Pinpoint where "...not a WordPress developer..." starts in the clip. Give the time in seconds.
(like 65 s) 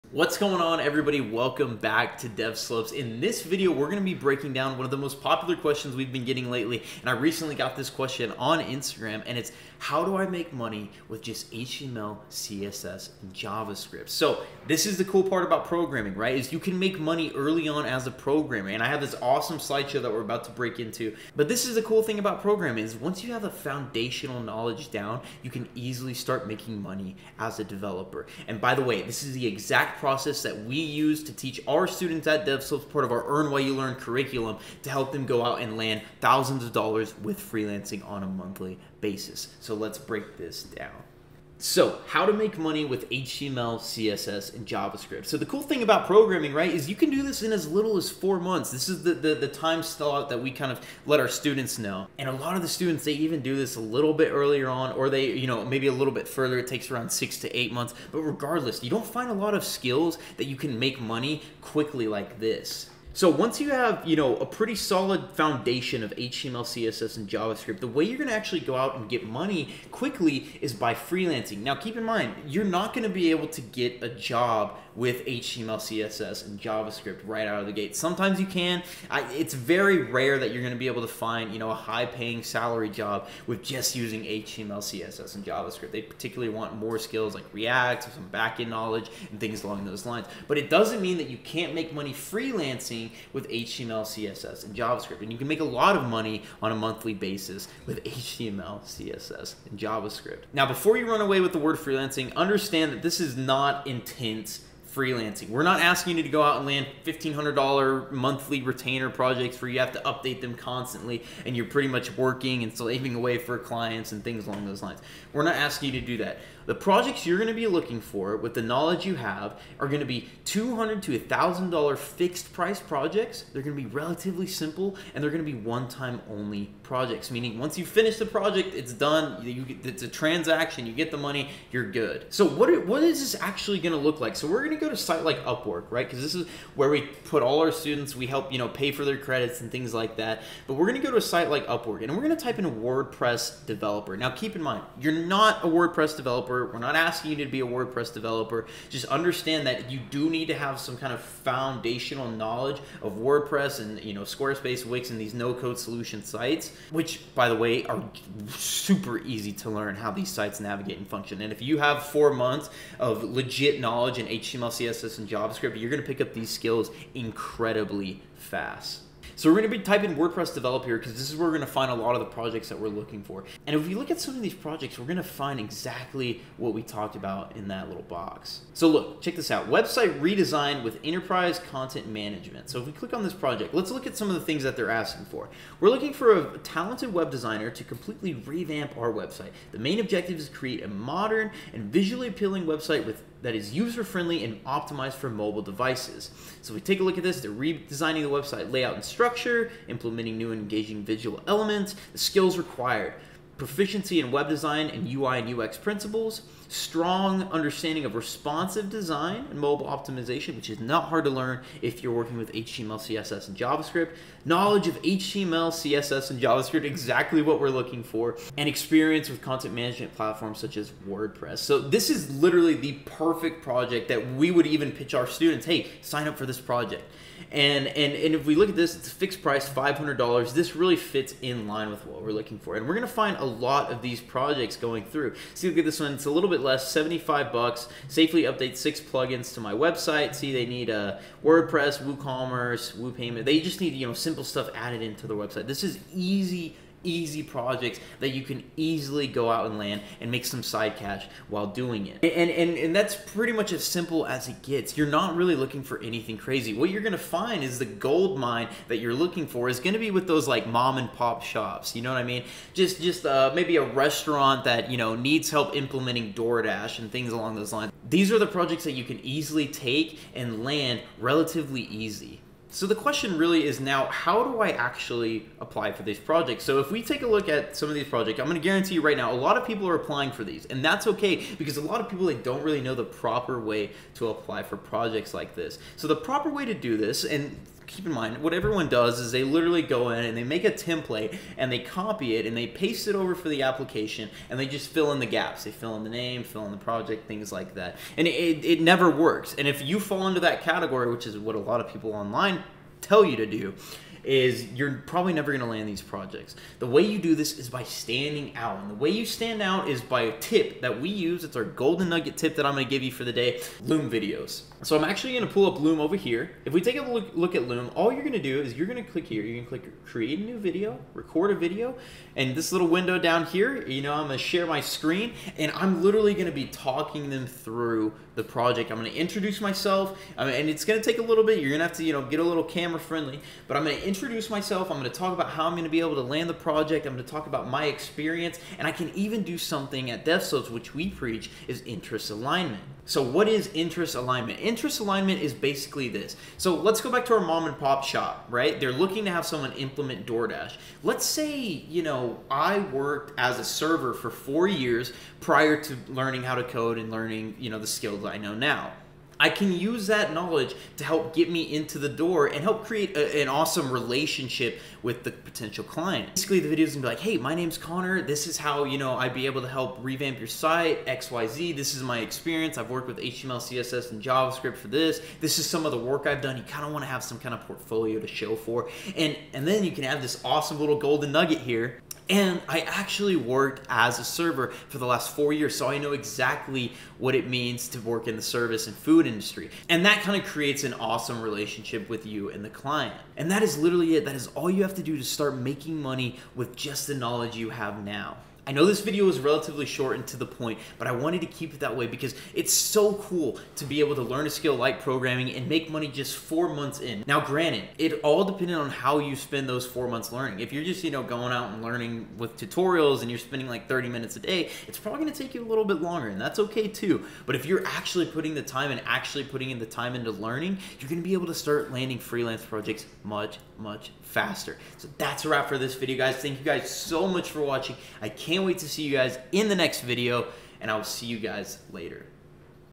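145 s.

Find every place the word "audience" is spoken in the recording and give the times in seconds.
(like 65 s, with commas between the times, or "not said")
not said.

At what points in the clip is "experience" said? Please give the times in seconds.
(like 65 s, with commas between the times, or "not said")
218 s, 337 s, 372 s.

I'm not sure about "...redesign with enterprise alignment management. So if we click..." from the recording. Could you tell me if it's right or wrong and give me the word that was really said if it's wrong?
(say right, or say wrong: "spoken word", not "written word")
wrong: "content", not "alignment".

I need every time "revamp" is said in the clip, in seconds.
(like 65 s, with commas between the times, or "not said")
188 s, 370 s.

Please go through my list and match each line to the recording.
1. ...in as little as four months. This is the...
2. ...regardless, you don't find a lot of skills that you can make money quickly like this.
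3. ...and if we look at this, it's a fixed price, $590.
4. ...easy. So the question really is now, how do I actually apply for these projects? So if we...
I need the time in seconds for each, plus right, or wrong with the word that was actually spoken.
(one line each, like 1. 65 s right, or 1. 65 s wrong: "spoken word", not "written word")
1. 47 s right
2. 58 s right
3. 228 s wrong: "500", not "590"
4. 271 s right.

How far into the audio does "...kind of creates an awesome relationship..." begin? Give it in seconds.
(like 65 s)
390 s.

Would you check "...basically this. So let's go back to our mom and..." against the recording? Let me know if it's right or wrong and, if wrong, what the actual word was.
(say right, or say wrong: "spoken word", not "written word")
right.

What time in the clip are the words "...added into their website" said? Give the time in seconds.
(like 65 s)
244 s.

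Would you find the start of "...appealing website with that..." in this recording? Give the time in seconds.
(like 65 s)
192 s.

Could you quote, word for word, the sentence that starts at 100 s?
Now, before you run away with the word freelancing, understand that this is not intense freelancing.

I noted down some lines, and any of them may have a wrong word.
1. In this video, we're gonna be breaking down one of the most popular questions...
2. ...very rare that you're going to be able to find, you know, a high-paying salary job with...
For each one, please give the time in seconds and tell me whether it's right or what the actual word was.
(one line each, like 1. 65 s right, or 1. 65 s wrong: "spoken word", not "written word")
1. 2 s right
2. 79 s right.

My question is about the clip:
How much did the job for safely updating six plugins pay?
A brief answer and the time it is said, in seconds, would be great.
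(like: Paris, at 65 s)
$75, at 236 s.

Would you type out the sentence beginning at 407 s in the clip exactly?
Now, granted, it all depended on how you spend those four months learning.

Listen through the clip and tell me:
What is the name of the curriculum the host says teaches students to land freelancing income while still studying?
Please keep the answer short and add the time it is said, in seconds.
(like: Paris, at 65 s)
Earn While You Learn, at 33 s.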